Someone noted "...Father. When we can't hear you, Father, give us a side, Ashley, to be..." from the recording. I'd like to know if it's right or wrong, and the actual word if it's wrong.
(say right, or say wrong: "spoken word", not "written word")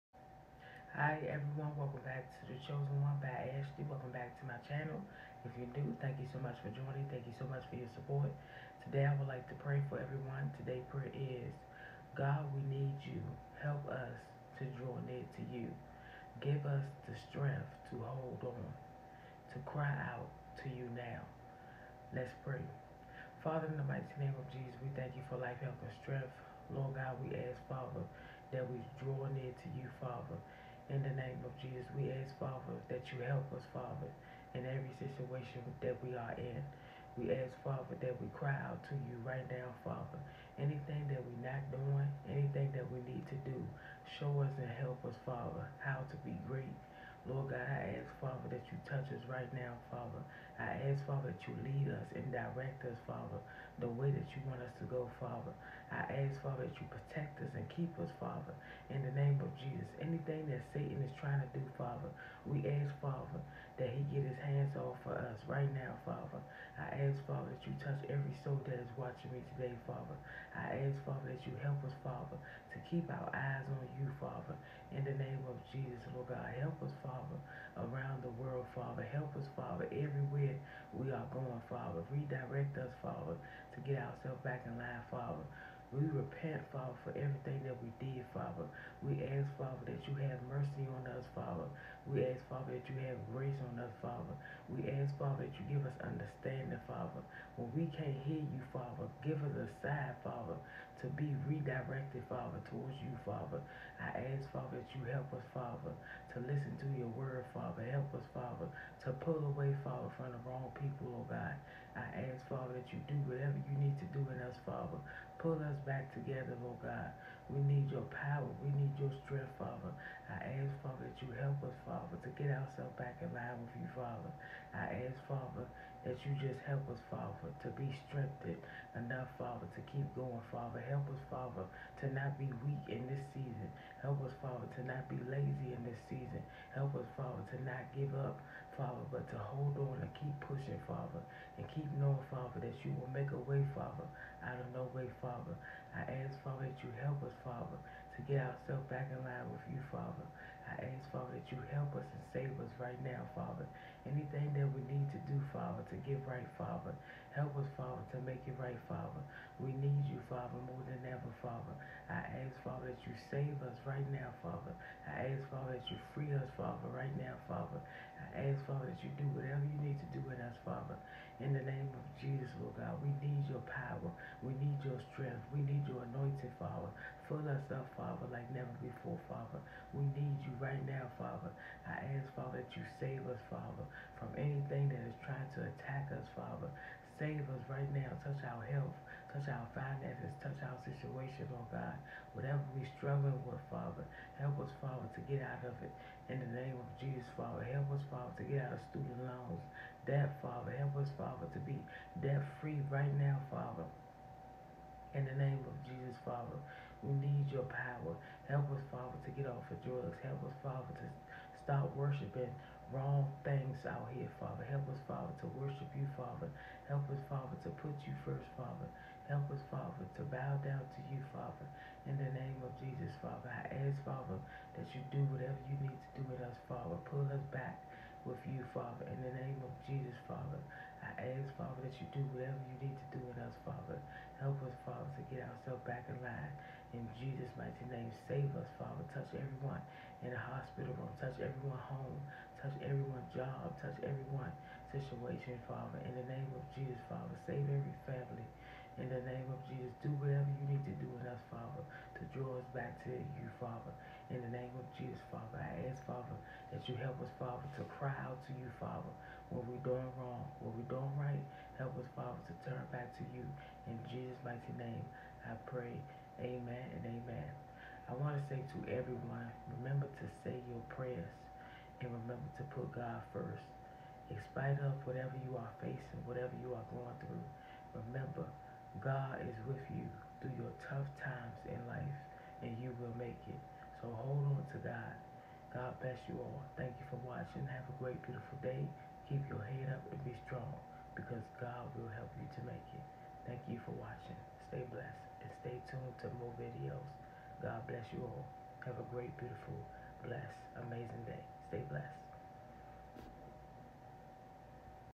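wrong: "Father", not "Ashley".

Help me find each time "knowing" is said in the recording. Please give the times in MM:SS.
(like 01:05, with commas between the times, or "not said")
02:22.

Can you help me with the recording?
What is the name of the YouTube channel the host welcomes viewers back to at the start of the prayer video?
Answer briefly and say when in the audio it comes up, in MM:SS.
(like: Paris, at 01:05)
The Chosen One by Ashley, at 00:02.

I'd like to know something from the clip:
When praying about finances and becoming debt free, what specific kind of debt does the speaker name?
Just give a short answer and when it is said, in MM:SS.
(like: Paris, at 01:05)
student loans, at 03:18.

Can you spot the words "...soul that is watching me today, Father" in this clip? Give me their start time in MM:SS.
01:08.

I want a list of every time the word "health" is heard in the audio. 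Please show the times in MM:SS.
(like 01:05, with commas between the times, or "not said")
00:25, 03:08.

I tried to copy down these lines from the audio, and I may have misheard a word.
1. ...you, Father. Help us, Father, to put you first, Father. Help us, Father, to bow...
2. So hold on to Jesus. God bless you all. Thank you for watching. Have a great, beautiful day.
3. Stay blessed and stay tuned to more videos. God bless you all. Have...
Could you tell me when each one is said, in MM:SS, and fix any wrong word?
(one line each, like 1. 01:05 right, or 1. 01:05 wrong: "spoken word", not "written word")
1. 03:35 right
2. 04:44 wrong: "God", not "Jesus"
3. 04:54 right.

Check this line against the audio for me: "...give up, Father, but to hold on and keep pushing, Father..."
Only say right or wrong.
right.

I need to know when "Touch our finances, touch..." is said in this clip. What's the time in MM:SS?
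03:09.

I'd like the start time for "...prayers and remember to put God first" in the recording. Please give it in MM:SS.
04:30.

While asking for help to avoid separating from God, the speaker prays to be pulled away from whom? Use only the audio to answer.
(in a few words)
the wrong people.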